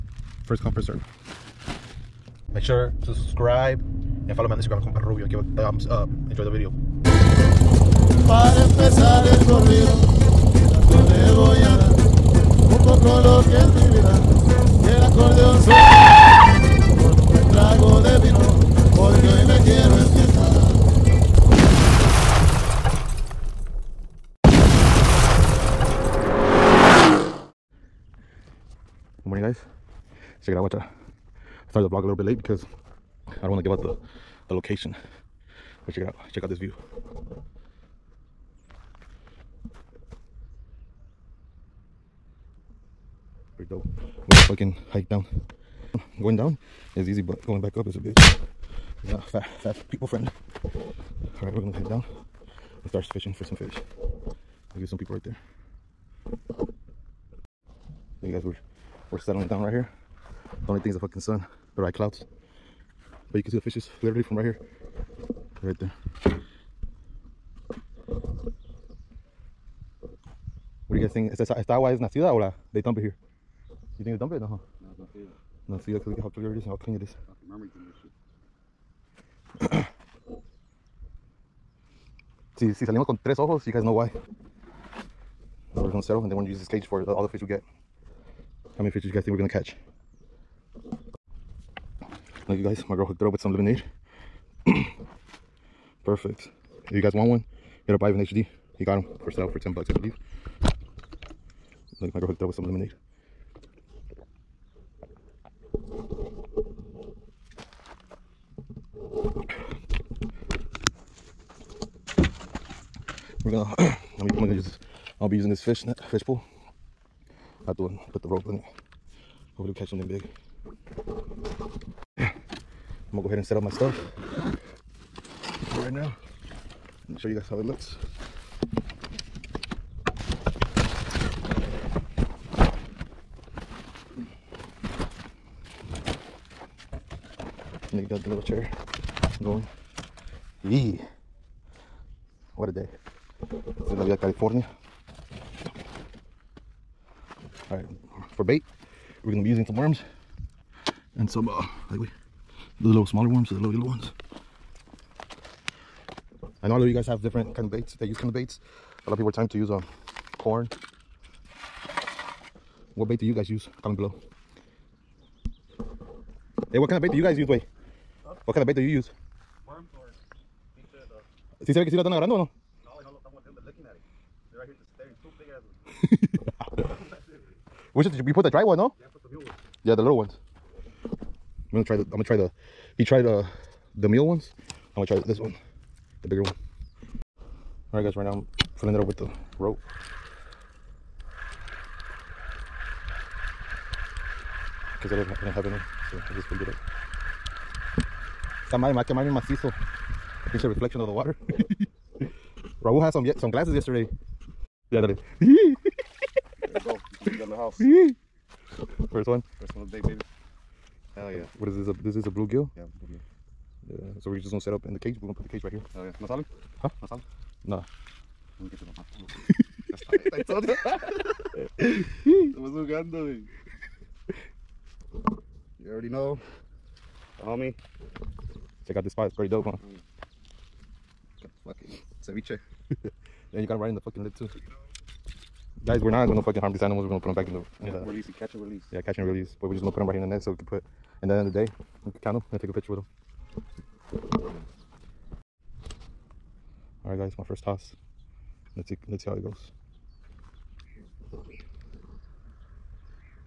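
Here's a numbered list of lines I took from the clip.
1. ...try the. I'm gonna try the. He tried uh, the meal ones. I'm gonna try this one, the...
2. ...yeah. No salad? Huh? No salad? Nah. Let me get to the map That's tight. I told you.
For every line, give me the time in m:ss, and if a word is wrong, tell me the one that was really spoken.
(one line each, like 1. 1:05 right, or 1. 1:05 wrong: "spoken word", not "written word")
1. 3:01 right
2. 3:36 right.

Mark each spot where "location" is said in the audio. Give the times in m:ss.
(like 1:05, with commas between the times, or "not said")
0:34.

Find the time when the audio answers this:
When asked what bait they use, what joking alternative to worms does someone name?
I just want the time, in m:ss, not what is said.
2:50.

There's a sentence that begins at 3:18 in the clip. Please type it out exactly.
Esa madre me va a mi macizo.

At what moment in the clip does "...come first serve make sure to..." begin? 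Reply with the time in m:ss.
0:00.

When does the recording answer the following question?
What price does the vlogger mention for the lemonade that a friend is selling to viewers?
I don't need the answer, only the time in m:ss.
1:39.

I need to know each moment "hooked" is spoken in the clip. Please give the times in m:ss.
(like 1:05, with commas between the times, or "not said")
1:33, 1:42.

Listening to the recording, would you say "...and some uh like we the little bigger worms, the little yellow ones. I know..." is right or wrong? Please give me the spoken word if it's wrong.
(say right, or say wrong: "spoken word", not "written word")
wrong: "smaller", not "bigger".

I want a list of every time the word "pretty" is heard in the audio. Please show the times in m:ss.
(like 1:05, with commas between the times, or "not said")
0:43, 3:49.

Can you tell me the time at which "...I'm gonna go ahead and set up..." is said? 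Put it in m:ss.
2:02.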